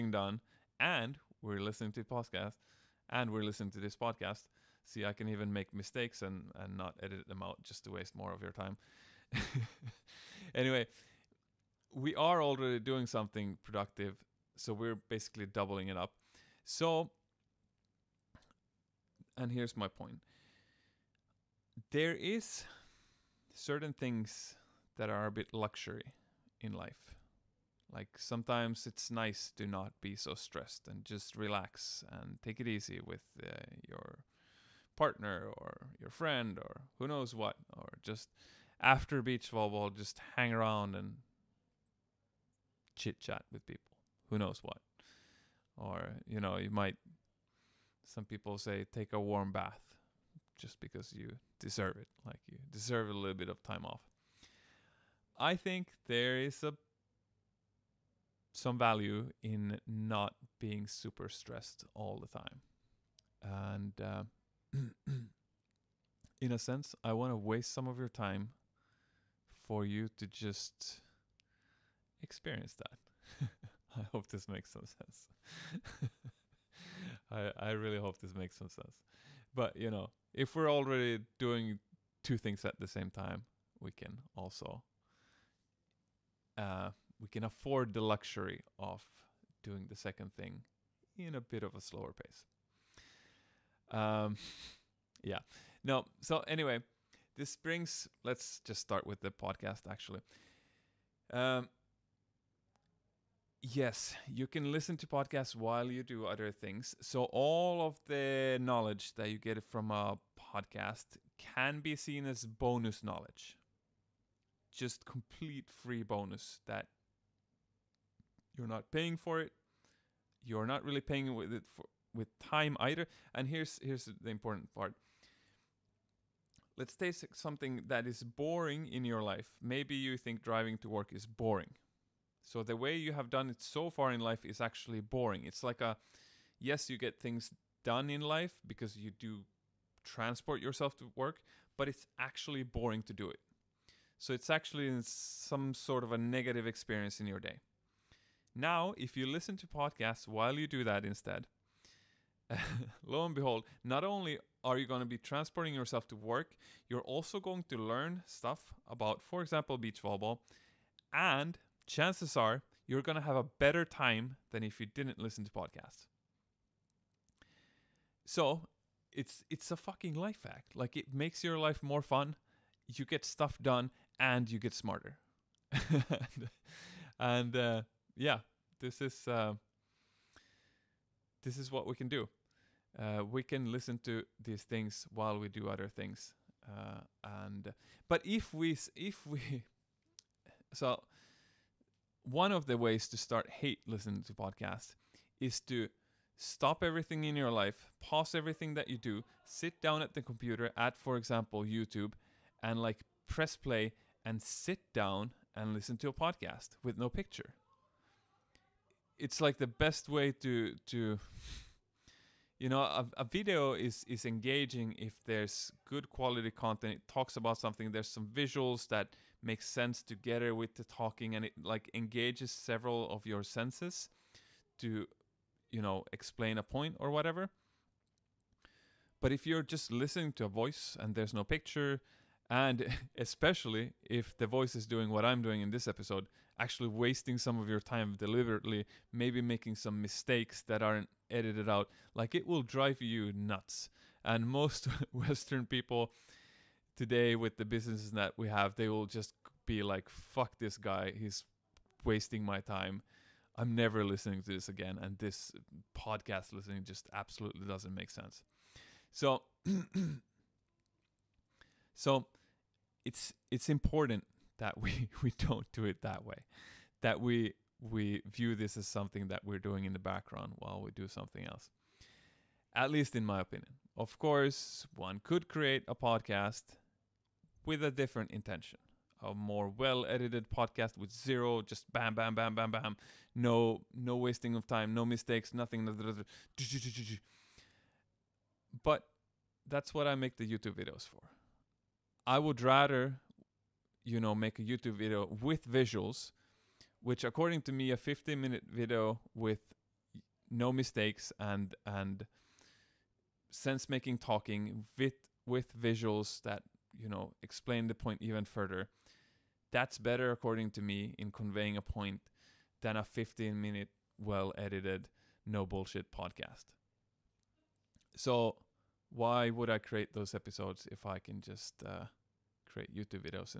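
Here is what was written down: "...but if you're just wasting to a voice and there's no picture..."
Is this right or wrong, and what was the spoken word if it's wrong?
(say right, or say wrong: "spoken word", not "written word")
wrong: "listening", not "wasting".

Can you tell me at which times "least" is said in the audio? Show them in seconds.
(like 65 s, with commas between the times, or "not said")
272 s.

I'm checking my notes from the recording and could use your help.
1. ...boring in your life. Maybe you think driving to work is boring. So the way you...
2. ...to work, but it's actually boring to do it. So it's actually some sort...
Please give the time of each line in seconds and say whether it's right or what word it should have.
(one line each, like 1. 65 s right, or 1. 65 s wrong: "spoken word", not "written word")
1. 128 s right
2. 140 s right.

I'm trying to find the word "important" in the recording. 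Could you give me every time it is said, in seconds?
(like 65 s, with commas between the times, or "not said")
124 s, 263 s.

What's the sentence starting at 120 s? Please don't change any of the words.
You're not really paying with it for, with time either.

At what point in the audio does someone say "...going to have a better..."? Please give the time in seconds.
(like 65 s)
163 s.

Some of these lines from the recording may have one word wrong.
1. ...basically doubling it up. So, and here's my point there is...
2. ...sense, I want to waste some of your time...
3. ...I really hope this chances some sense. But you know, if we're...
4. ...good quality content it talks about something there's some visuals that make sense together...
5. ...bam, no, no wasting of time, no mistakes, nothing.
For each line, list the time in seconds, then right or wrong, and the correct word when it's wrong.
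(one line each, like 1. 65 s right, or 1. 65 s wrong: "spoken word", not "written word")
1. 15 s right
2. 66 s right
3. 77 s wrong: "makes", not "chances"
4. 215 s right
5. 282 s right.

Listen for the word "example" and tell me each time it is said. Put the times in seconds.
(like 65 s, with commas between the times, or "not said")
159 s, 201 s.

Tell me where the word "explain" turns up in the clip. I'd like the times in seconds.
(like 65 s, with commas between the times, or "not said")
226 s, 307 s.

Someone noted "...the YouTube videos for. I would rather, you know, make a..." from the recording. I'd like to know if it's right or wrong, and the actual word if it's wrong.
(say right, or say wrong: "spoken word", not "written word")
right.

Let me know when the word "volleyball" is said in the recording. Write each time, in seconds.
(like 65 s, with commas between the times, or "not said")
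39 s, 160 s.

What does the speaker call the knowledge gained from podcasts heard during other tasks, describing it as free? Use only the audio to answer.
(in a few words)
bonus knowledge.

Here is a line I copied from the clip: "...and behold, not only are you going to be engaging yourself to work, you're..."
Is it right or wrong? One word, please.
wrong.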